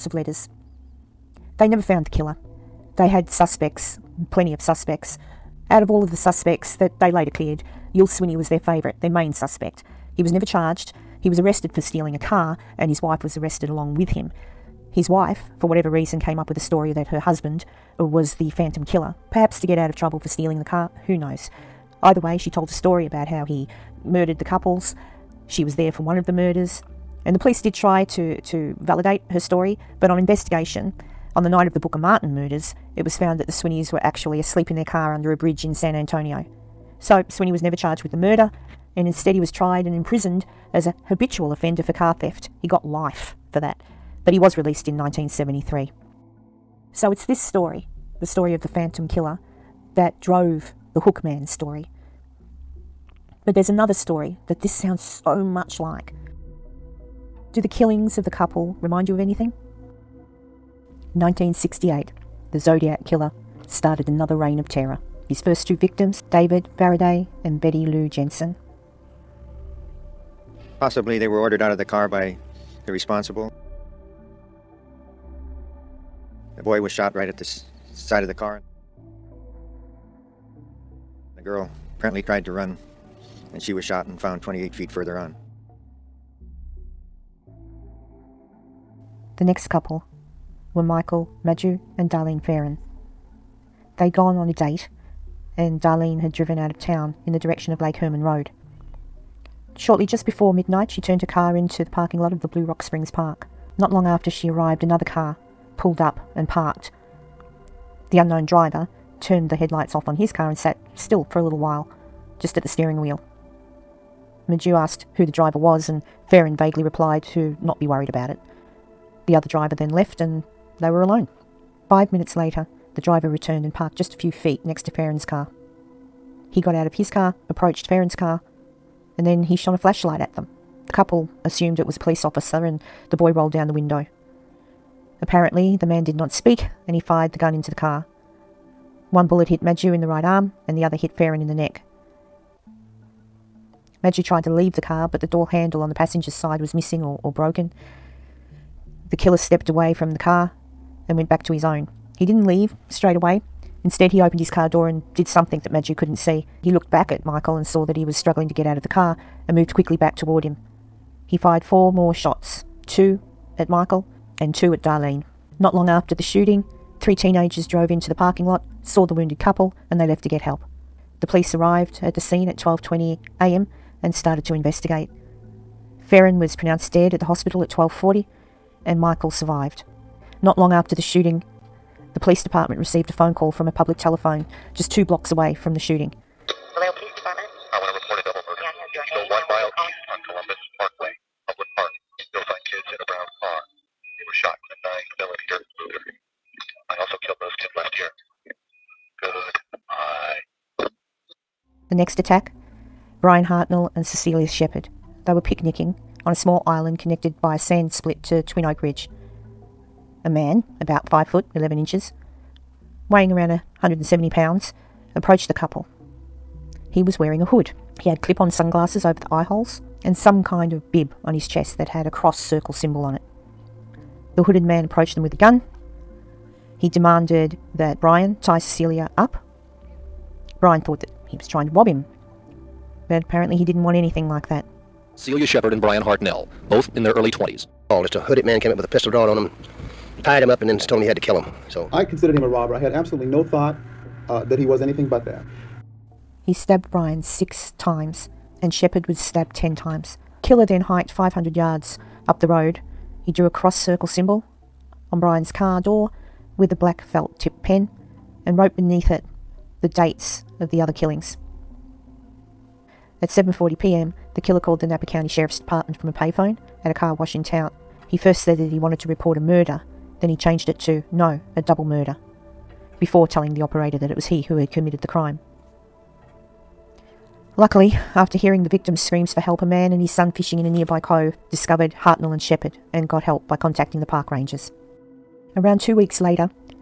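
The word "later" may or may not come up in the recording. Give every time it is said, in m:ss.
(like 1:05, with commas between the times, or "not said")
0:07, 2:02, 4:46.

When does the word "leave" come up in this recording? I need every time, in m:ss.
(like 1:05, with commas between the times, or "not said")
2:24, 2:32.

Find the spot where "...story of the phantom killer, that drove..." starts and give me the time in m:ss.
0:48.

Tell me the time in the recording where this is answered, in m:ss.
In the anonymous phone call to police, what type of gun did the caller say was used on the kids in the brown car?
3:15.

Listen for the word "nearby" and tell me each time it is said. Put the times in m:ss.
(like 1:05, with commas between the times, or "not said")
4:40.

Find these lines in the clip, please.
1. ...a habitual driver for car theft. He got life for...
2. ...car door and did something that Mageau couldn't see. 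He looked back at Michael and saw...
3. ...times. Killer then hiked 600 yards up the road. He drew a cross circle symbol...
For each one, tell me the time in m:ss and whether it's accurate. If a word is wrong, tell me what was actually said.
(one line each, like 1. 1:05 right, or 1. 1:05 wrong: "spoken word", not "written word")
1. 0:40 wrong: "offender", not "driver"
2. 2:34 right
3. 4:09 wrong: "500", not "600".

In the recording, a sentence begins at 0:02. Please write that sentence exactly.
They had suspects, plenty of suspects.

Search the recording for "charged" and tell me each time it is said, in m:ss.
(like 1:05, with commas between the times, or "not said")
0:10, 0:37.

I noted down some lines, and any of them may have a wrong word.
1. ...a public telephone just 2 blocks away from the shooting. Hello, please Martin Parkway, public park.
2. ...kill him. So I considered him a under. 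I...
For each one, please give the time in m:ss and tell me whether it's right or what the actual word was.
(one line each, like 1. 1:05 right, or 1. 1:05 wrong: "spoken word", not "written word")
1. 3:03 wrong: "Columbus", not "Martin"
2. 4:01 wrong: "robber", not "under".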